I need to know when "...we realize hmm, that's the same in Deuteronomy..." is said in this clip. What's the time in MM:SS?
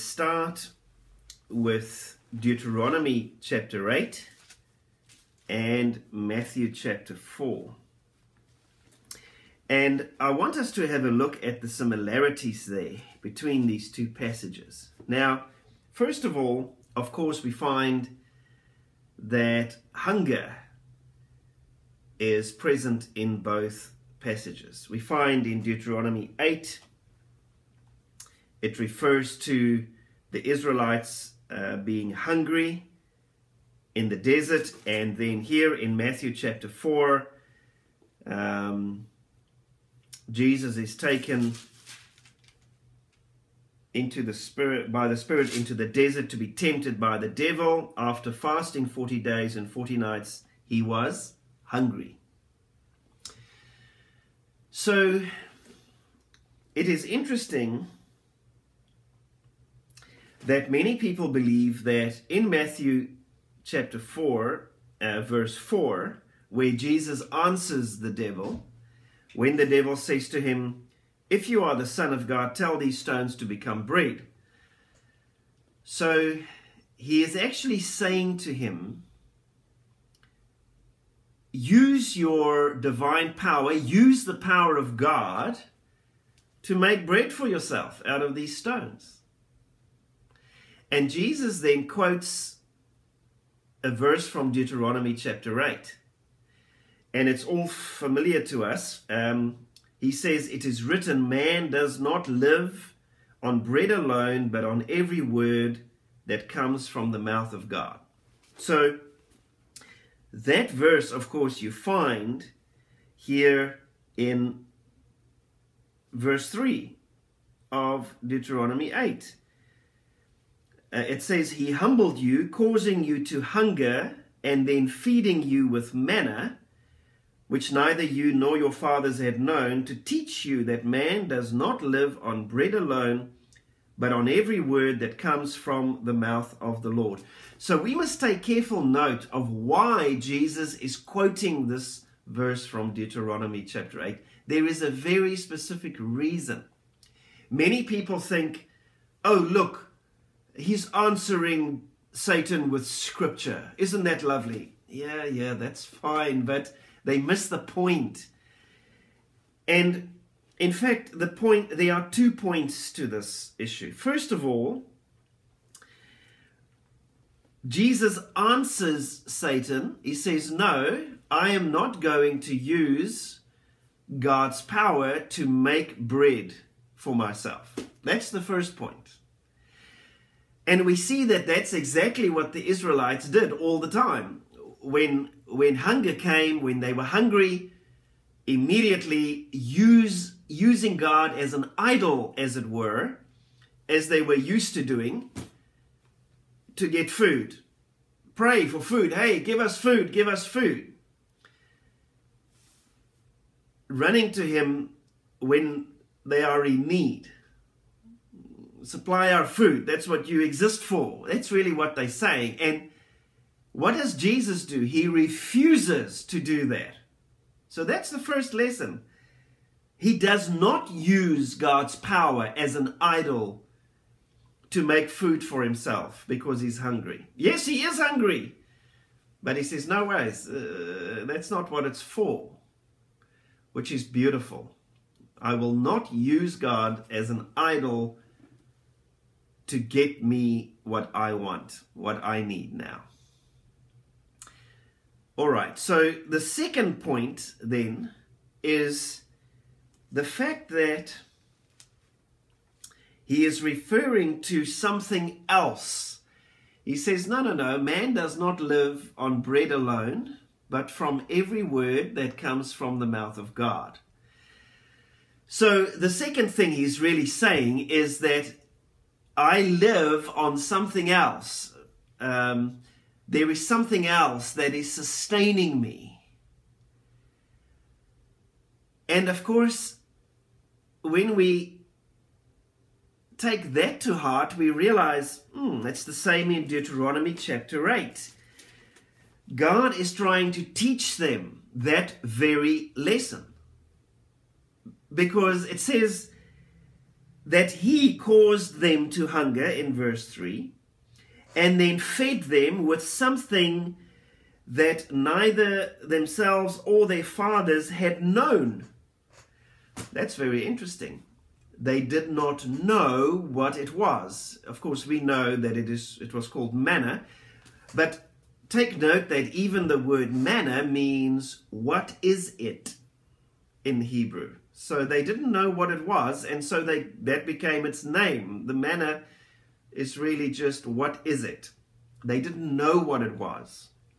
04:44.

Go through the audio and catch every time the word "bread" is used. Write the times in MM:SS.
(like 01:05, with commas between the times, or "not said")
01:13, 01:27, 01:43, 02:12, 02:55, 04:19.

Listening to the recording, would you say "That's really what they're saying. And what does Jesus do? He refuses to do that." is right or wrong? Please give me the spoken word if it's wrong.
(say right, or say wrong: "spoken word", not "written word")
right.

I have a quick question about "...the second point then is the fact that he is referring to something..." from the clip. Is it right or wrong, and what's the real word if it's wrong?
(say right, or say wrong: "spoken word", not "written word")
right.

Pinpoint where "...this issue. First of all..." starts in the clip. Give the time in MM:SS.
02:43.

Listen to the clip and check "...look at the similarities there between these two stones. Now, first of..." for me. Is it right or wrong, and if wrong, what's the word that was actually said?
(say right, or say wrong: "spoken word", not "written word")
wrong: "passages", not "stones".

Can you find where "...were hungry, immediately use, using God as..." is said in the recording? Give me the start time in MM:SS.
03:06.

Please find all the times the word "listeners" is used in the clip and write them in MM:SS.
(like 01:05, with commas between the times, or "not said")
not said.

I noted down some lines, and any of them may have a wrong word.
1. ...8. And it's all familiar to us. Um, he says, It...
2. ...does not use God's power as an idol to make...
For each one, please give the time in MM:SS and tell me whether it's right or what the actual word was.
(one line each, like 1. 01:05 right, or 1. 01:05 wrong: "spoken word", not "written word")
1. 01:35 right
2. 03:40 right.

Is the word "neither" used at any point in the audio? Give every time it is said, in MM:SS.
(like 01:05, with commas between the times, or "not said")
02:07, 05:05.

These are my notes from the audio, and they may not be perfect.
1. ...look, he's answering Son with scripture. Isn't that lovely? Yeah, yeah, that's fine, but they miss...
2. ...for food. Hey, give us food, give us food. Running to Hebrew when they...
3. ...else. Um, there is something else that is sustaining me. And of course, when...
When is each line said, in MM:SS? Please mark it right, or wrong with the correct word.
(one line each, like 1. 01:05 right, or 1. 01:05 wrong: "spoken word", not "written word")
1. 02:29 wrong: "Satan", not "Son"
2. 03:18 wrong: "Him", not "Hebrew"
3. 04:31 right.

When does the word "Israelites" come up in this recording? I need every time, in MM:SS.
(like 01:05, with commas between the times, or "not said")
00:30, 03:02.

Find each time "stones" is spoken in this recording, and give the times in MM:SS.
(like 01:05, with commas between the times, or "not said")
01:12, 01:28.